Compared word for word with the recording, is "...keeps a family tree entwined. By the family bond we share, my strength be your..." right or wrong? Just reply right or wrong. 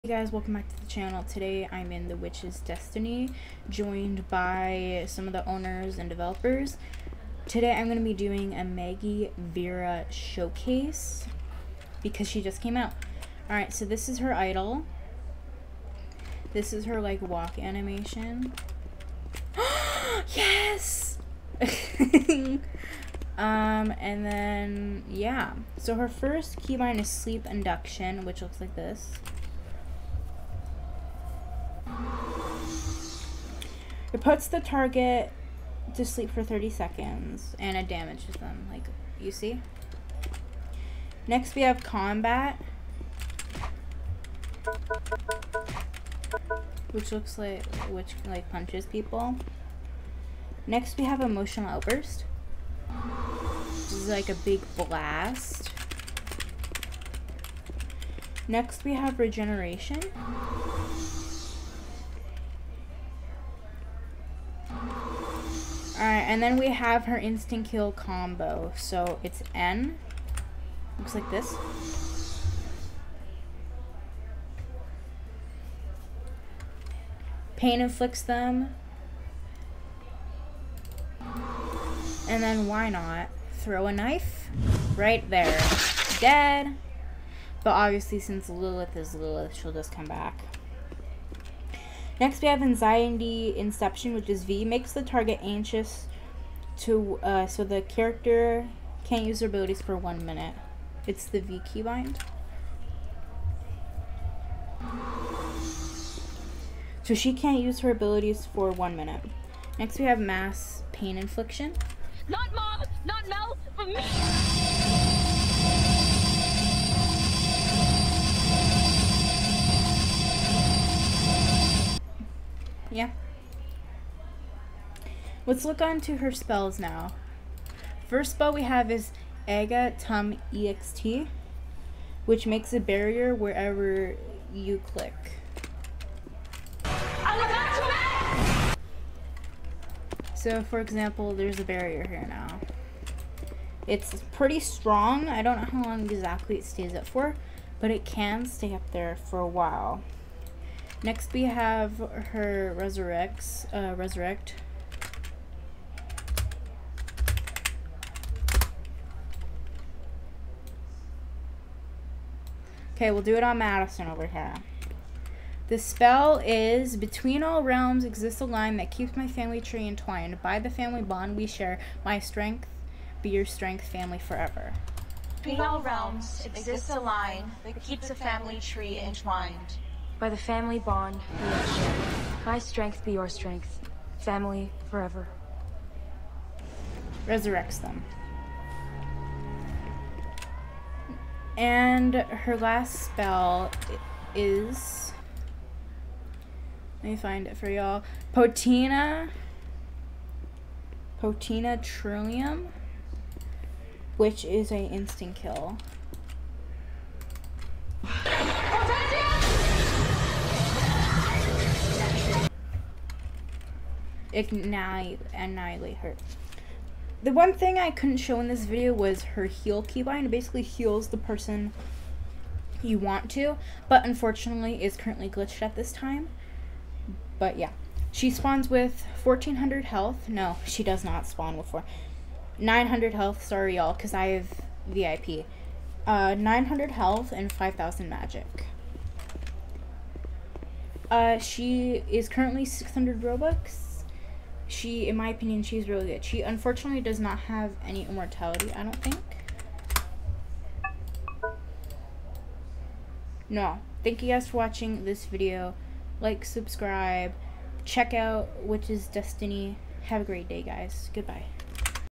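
right.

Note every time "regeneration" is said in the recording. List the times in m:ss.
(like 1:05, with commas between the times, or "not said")
0:59.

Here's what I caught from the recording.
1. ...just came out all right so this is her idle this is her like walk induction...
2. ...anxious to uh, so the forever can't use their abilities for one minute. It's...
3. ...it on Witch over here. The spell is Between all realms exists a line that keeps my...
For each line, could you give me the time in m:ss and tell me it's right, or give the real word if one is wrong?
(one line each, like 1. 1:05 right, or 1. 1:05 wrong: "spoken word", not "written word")
1. 0:12 wrong: "animation", not "induction"
2. 1:35 wrong: "character", not "forever"
3. 2:43 wrong: "Madison", not "Witch".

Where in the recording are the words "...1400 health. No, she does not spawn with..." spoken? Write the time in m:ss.
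3:49.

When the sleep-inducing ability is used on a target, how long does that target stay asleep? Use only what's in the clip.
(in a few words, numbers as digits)
30 seconds.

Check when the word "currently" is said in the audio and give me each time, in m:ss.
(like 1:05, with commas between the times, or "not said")
3:44, 4:02.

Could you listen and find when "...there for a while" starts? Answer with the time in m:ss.
2:28.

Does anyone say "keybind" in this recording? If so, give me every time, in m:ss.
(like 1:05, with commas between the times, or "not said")
0:26, 1:41, 3:39.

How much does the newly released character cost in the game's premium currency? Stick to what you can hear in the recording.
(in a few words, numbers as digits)
600 Robux.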